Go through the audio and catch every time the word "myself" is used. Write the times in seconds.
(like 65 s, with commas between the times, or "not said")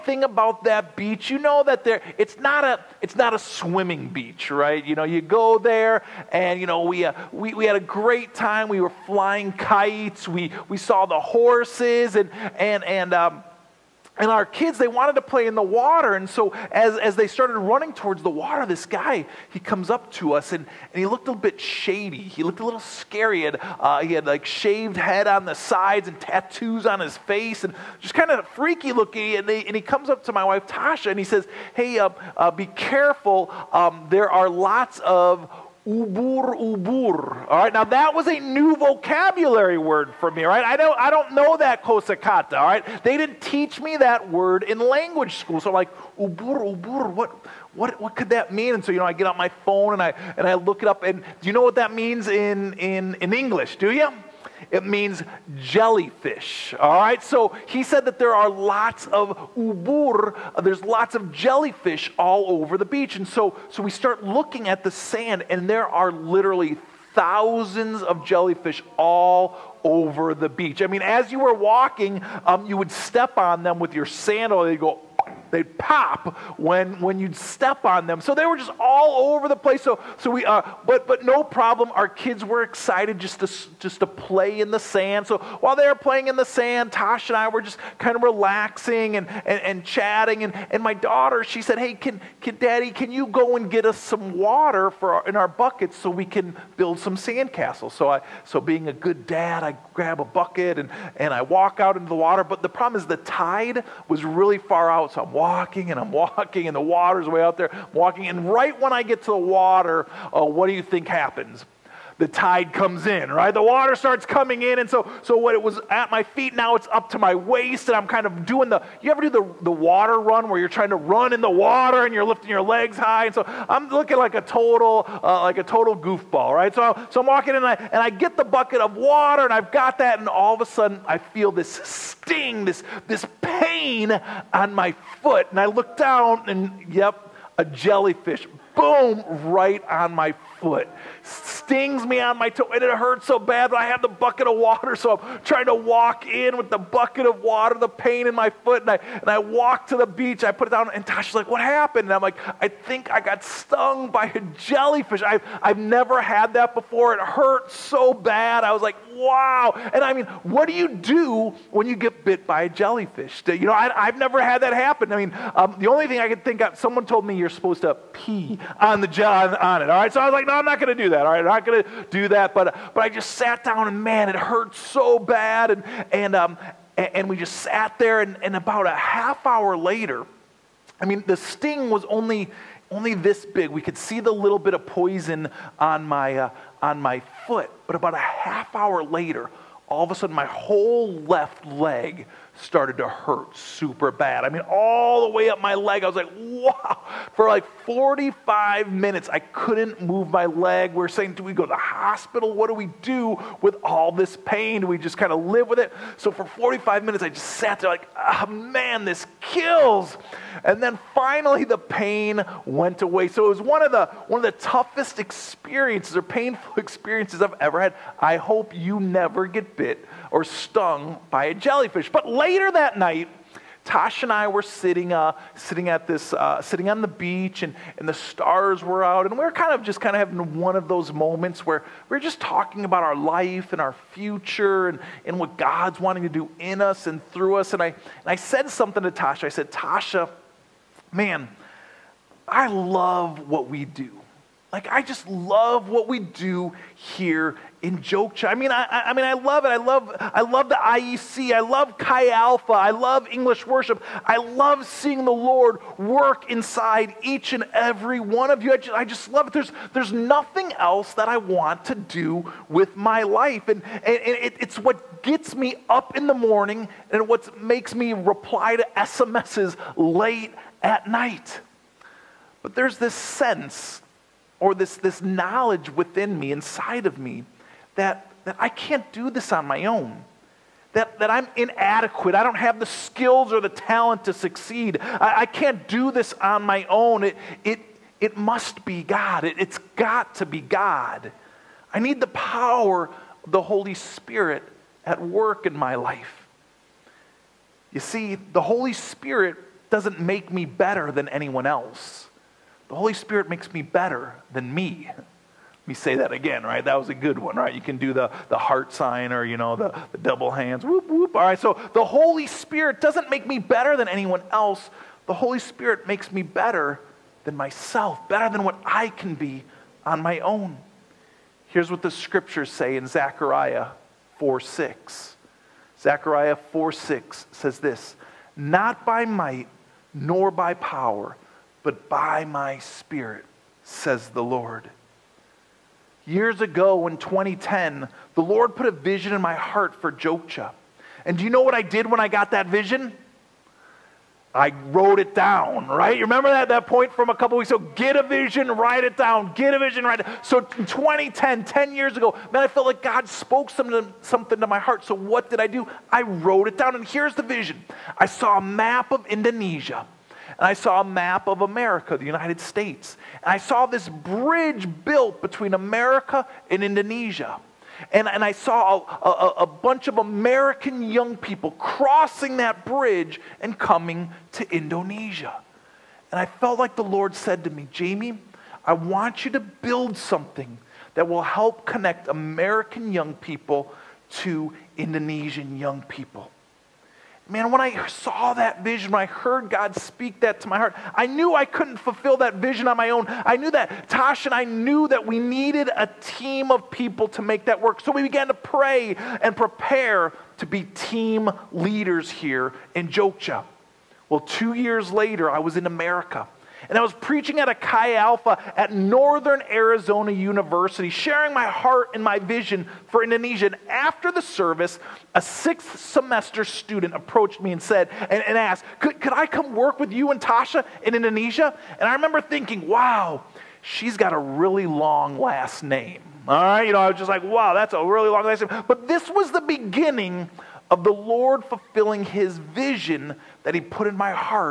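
317 s.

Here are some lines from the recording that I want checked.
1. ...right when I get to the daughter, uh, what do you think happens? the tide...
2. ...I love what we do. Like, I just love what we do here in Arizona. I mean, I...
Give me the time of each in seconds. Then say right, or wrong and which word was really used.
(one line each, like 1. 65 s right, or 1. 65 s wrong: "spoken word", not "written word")
1. 108 s wrong: "water", not "daughter"
2. 242 s wrong: "Jogja", not "Arizona".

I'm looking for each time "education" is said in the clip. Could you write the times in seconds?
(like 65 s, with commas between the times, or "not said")
not said.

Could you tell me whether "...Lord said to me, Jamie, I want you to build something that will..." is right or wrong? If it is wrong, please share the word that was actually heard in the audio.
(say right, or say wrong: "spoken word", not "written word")
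right.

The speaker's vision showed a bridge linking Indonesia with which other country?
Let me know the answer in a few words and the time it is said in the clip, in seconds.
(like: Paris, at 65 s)
United States, at 362 s.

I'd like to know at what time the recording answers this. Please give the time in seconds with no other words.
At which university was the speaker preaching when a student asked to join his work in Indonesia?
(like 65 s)
408 s.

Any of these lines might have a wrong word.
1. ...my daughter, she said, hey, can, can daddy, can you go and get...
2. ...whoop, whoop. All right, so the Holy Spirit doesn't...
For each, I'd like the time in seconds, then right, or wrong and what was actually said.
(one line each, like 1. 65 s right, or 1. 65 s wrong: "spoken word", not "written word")
1. 90 s right
2. 310 s right.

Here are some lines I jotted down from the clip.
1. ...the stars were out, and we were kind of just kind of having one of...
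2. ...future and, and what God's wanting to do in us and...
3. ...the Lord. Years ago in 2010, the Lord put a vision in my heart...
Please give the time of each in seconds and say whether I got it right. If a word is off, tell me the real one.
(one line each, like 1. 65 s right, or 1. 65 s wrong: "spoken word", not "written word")
1. 228 s right
2. 234 s right
3. 334 s right.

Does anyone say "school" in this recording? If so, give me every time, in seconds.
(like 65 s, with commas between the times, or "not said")
45 s.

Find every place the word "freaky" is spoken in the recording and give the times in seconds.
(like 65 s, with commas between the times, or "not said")
28 s.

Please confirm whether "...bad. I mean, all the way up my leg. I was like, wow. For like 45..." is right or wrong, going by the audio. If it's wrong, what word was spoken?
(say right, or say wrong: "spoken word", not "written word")
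right.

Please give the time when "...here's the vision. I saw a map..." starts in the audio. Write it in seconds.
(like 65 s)
357 s.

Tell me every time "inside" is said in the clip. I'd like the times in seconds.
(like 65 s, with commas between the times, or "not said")
256 s, 276 s.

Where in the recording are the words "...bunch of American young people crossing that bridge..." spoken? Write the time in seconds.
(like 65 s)
369 s.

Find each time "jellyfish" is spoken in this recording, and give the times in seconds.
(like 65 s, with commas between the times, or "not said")
55 s, 61 s, 68 s, 137 s, 154 s, 162 s, 221 s.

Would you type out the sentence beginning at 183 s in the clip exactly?
We could see the little bit of poison on my, uh, on my foot.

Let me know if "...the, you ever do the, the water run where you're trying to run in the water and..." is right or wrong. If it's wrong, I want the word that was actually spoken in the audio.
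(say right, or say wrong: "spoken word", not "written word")
right.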